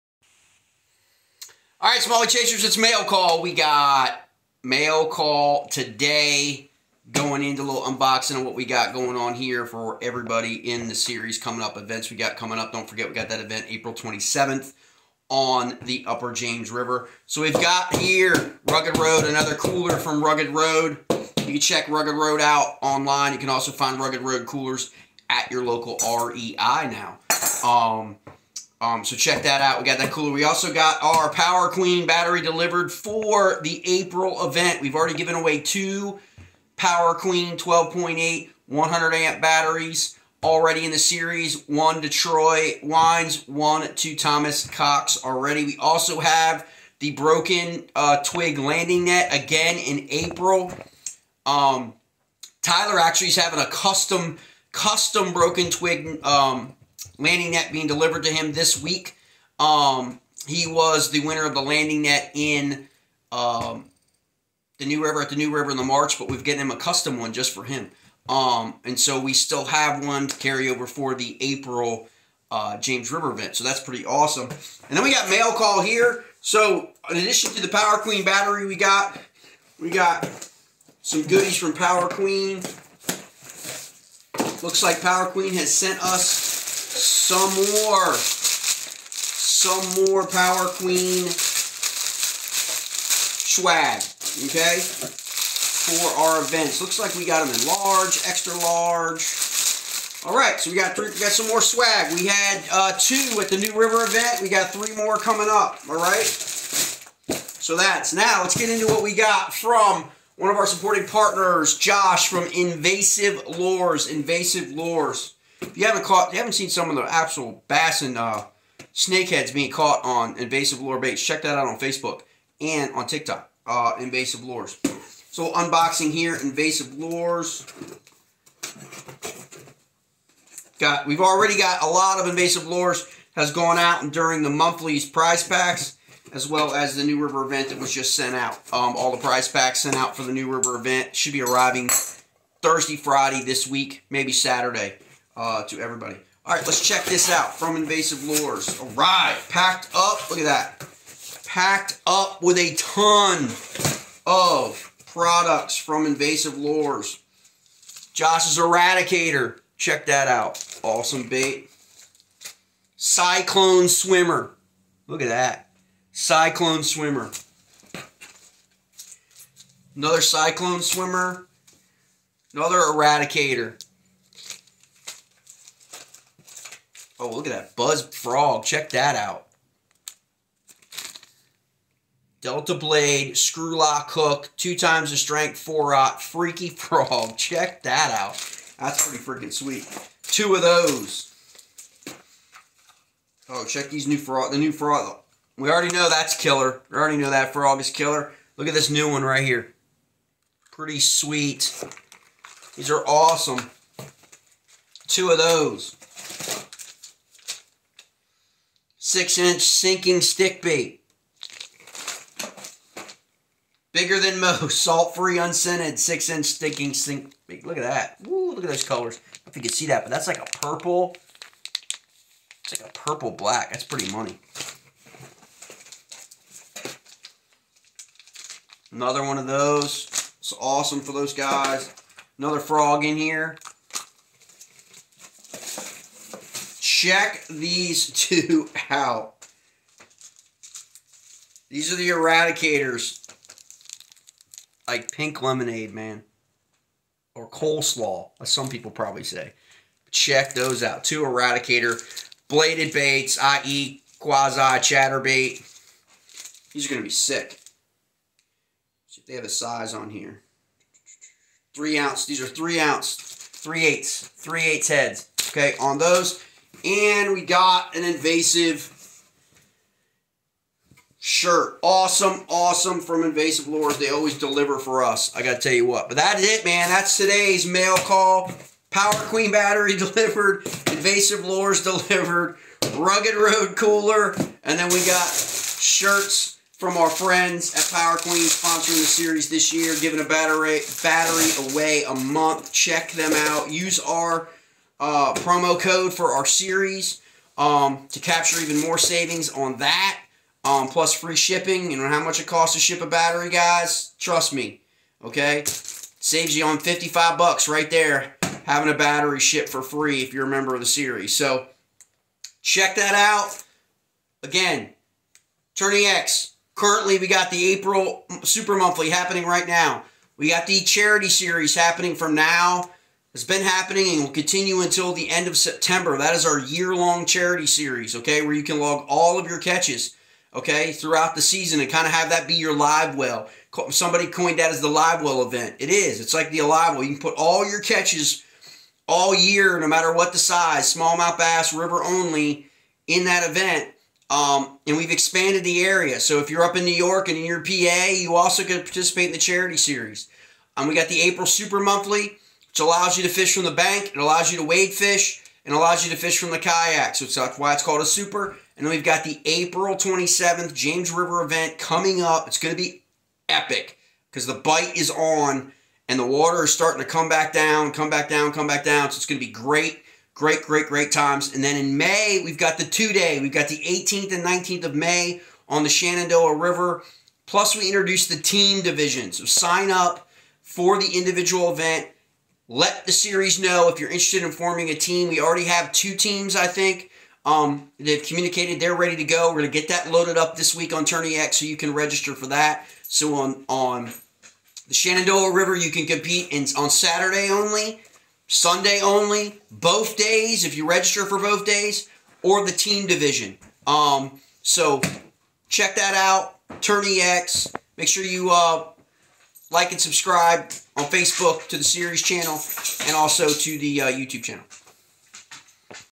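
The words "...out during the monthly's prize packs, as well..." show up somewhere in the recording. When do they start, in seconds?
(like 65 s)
133 s.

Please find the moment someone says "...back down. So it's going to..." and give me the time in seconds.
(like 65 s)
368 s.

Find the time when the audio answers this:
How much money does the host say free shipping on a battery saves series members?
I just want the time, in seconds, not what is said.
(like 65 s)
306 s.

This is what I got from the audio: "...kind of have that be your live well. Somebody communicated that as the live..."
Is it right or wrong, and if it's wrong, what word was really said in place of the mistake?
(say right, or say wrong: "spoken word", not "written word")
wrong: "coined", not "communicated".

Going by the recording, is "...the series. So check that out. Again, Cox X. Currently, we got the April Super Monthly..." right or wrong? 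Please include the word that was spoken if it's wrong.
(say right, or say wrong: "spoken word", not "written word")
wrong: "Tourney", not "Cox".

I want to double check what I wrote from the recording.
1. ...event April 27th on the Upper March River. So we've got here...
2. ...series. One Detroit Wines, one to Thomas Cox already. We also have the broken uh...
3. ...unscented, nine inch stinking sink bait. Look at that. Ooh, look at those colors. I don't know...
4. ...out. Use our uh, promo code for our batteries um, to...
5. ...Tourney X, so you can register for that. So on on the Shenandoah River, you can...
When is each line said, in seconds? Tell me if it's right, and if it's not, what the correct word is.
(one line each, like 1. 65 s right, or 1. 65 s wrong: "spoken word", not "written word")
1. 13 s wrong: "James", not "March"
2. 40 s right
3. 215 s wrong: "six", not "nine"
4. 293 s wrong: "series", not "batteries"
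5. 391 s right.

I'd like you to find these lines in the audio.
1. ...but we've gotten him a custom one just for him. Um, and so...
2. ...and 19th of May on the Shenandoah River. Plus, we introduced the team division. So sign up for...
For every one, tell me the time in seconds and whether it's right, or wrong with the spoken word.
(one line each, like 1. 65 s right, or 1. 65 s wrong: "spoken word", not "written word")
1. 66 s right
2. 374 s right.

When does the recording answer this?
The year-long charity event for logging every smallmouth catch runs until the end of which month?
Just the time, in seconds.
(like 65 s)
325 s.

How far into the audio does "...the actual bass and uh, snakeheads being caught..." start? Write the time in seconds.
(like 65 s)
116 s.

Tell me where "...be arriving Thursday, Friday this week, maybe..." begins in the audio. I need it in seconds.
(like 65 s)
141 s.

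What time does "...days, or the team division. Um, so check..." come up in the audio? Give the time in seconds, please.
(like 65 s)
401 s.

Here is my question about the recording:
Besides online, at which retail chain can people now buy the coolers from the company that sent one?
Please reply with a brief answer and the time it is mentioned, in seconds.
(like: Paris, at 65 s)
REI, at 26 s.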